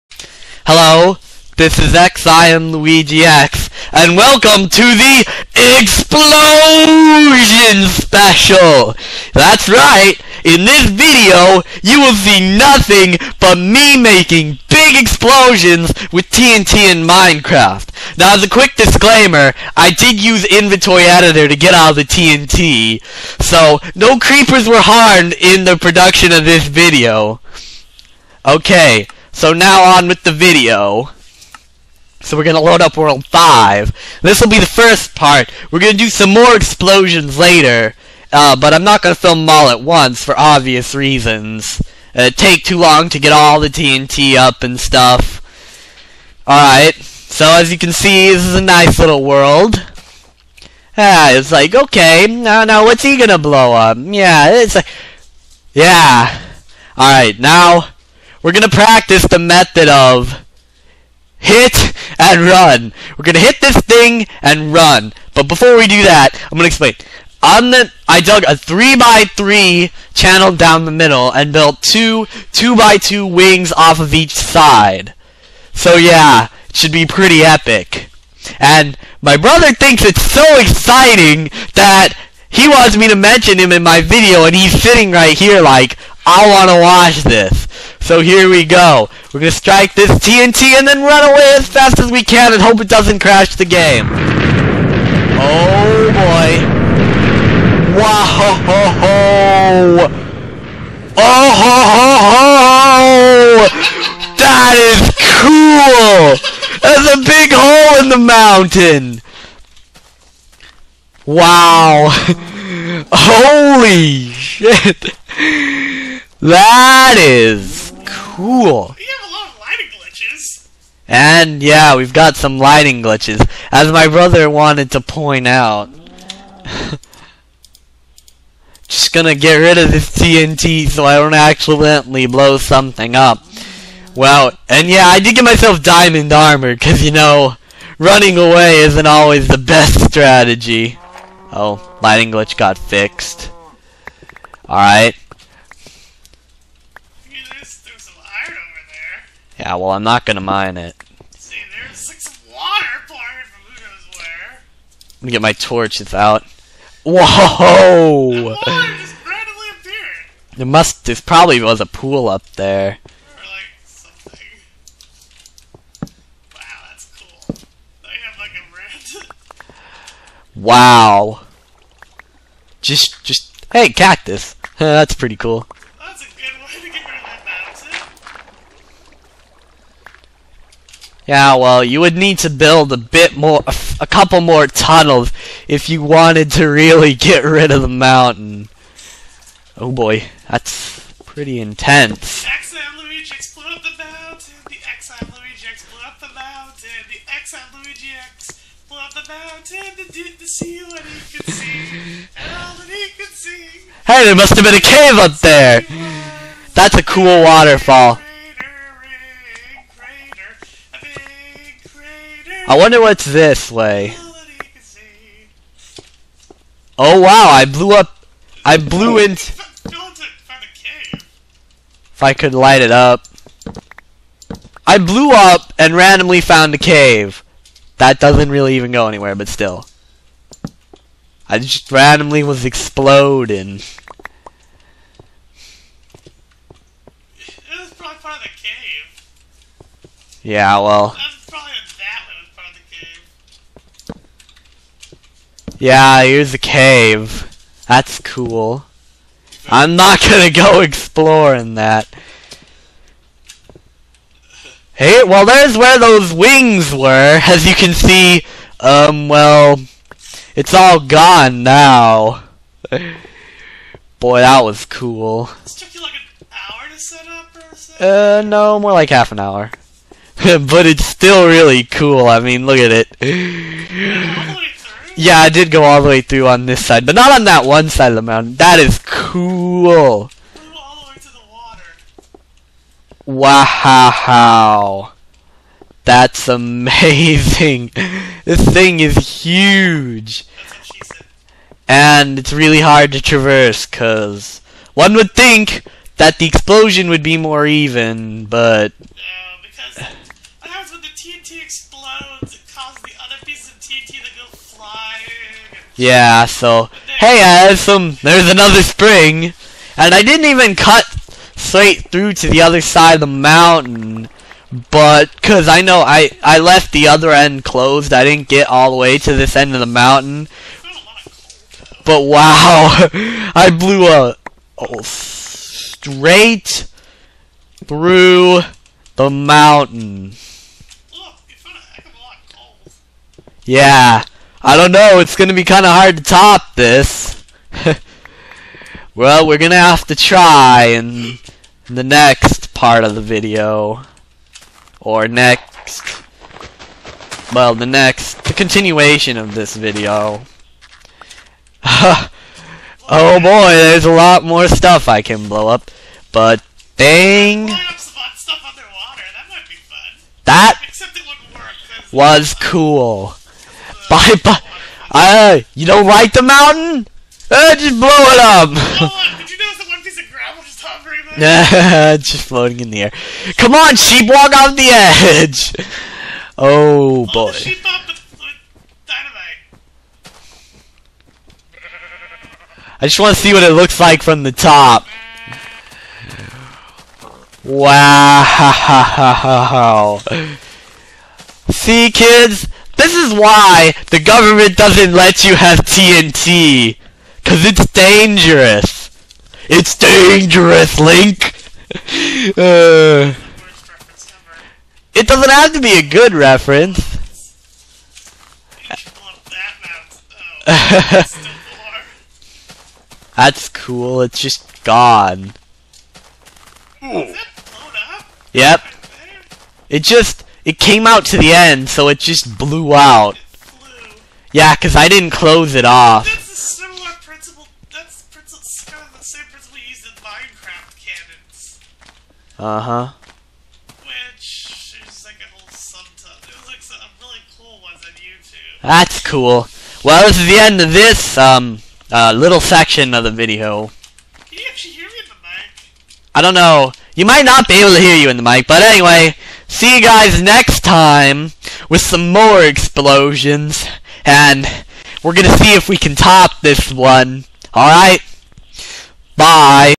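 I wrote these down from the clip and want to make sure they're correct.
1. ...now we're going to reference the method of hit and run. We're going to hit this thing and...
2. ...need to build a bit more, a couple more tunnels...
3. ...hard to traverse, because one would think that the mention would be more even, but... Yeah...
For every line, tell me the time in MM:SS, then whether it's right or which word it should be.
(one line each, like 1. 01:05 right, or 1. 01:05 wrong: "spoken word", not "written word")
1. 00:57 wrong: "practice", not "reference"
2. 03:02 right
3. 04:52 wrong: "explosion", not "mention".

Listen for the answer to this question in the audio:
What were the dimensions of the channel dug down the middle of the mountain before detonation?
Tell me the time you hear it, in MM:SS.
01:08.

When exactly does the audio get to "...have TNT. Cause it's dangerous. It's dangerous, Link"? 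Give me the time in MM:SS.
06:35.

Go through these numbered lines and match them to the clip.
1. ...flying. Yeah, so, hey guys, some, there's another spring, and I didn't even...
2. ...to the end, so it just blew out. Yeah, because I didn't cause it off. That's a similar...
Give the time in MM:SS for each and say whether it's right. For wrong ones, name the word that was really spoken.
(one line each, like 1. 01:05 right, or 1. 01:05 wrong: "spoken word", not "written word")
1. 05:04 right
2. 07:01 wrong: "close", not "cause".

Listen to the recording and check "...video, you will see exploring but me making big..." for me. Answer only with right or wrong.
wrong.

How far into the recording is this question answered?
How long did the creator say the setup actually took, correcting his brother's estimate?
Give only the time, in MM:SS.
04:29.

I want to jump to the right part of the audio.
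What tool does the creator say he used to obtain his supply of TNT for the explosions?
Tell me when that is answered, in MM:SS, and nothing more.
00:20.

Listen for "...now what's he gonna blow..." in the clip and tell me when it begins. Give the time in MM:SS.
00:52.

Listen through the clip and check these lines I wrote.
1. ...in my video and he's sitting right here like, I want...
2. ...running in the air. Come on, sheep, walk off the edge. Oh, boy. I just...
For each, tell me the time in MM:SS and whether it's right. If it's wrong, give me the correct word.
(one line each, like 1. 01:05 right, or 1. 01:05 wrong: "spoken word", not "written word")
1. 01:23 right
2. 06:12 wrong: "floating", not "running".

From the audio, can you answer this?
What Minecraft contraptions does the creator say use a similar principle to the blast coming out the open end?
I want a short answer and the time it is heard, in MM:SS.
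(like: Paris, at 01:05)
Minecraft cannons, at 07:10.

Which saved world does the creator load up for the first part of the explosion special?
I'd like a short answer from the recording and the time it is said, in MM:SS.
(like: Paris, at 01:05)
World 5, at 00:32.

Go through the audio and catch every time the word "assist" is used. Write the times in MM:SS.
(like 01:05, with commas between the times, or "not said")
not said.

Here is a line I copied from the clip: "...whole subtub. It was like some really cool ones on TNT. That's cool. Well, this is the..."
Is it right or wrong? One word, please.
wrong.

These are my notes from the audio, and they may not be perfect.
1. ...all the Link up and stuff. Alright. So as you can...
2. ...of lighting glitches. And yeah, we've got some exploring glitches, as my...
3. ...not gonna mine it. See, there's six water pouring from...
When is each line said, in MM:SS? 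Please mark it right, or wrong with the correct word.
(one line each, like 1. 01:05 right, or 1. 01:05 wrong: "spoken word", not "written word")
1. 00:43 wrong: "TNT", not "Link"
2. 01:59 wrong: "lighting", not "exploring"
3. 02:30 right.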